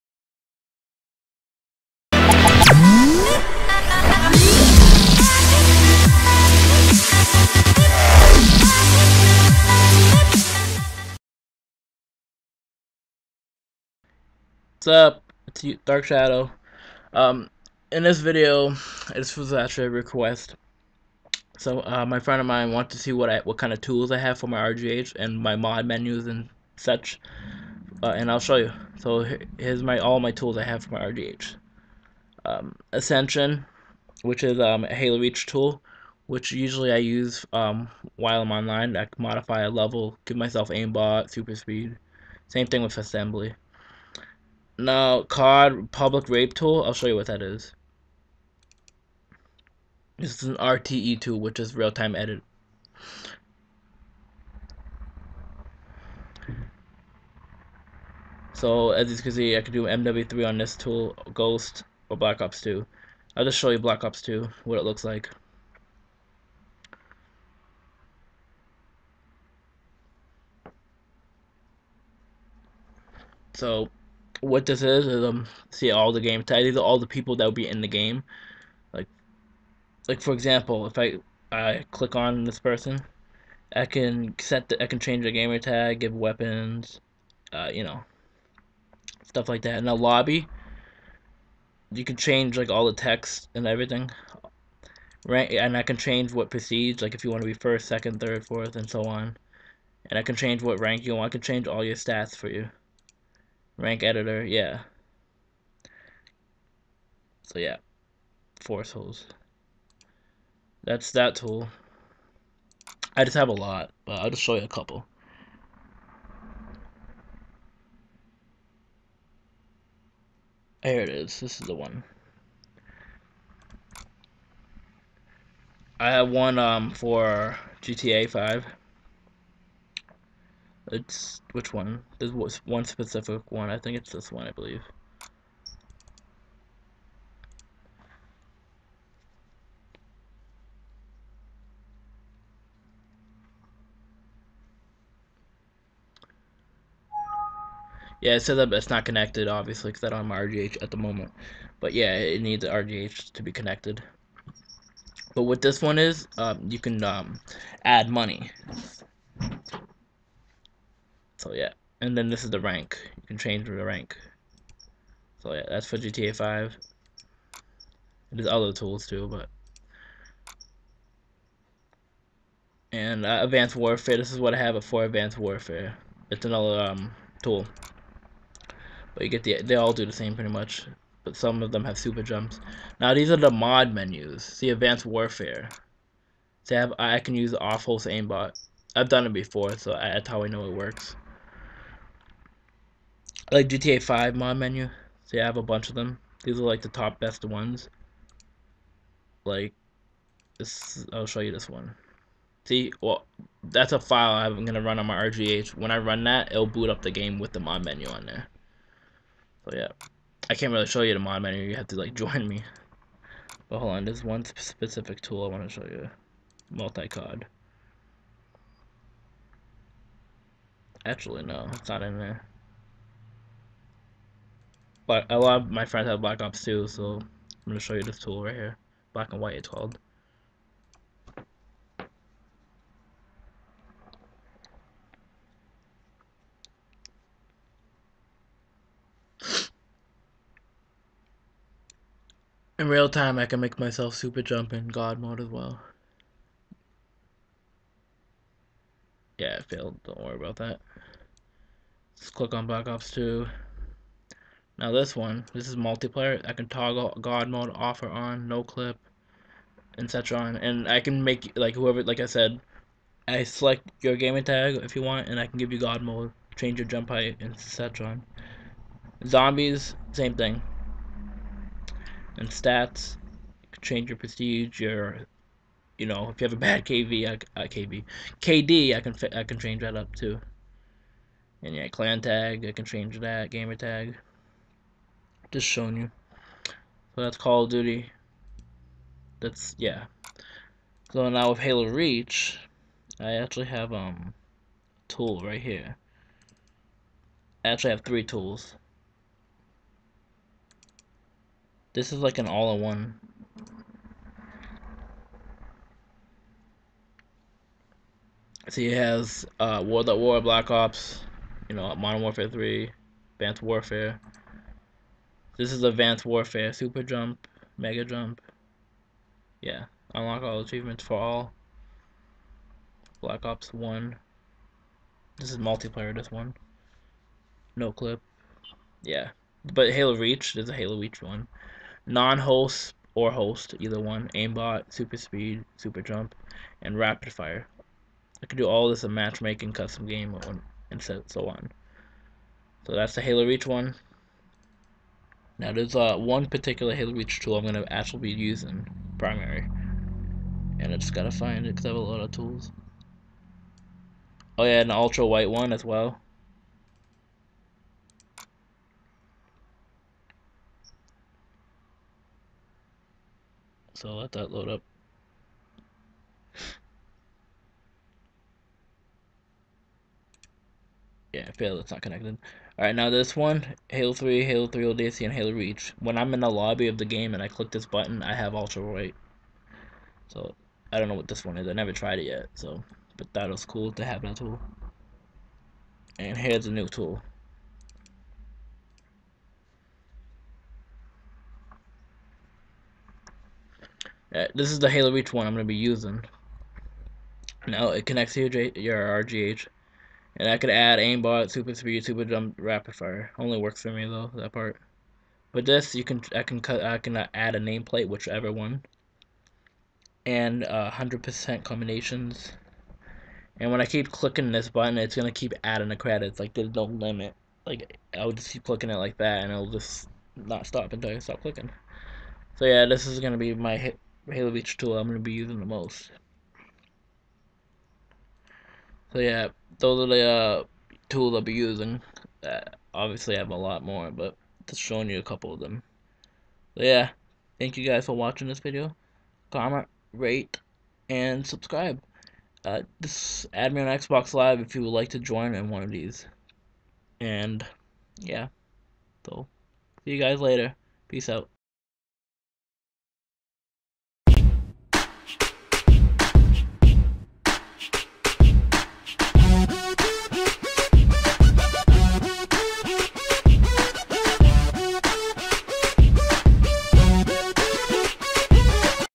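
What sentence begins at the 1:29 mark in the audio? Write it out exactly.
In a lobby, you can change like all the text and everything.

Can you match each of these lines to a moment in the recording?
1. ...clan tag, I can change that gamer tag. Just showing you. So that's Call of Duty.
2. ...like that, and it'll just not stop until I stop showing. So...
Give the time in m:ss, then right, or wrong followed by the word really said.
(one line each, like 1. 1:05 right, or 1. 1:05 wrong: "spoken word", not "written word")
1. 4:41 right
2. 6:58 wrong: "clicking", not "showing".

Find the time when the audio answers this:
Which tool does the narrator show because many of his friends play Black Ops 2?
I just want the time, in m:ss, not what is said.
3:49.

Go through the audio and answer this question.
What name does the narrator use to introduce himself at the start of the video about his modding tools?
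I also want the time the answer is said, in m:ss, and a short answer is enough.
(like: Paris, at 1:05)
Dark Shadow, at 0:15.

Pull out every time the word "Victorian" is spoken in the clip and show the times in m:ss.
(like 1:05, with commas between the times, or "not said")
not said.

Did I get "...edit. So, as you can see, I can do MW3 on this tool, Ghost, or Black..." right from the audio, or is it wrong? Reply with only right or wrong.
right.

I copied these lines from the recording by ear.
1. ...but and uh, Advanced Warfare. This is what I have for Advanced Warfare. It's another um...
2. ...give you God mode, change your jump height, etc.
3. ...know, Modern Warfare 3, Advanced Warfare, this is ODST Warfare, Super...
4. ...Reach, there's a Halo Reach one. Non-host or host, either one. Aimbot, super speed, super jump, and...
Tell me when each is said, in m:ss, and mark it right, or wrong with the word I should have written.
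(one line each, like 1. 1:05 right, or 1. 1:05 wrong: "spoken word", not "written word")
1. 2:49 right
2. 4:25 right
3. 5:11 wrong: "Advanced", not "ODST"
4. 5:30 right.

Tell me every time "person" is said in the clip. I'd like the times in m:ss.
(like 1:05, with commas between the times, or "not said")
1:22.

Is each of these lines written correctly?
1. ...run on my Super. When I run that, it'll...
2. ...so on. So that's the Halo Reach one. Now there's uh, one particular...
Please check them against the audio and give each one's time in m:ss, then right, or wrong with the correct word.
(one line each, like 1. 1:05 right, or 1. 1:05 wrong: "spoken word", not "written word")
1. 3:24 wrong: "RGH", not "Super"
2. 5:41 right.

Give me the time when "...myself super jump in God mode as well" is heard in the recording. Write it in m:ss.
4:03.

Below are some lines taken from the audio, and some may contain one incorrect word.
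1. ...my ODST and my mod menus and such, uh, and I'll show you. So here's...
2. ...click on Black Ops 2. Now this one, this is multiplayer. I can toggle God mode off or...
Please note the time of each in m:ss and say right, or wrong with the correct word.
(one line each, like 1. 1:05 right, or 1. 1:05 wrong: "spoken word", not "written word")
1. 0:24 wrong: "RGH", not "ODST"
2. 4:12 right.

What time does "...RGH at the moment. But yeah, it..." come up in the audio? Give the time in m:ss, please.
2:30.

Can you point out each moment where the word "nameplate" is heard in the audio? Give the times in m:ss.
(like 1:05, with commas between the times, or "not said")
6:47.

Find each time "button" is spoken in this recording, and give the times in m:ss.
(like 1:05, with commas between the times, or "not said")
6:17, 6:54.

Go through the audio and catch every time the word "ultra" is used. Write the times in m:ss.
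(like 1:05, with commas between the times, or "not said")
5:54, 6:18.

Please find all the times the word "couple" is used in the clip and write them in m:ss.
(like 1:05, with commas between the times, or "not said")
1:54, 7:15.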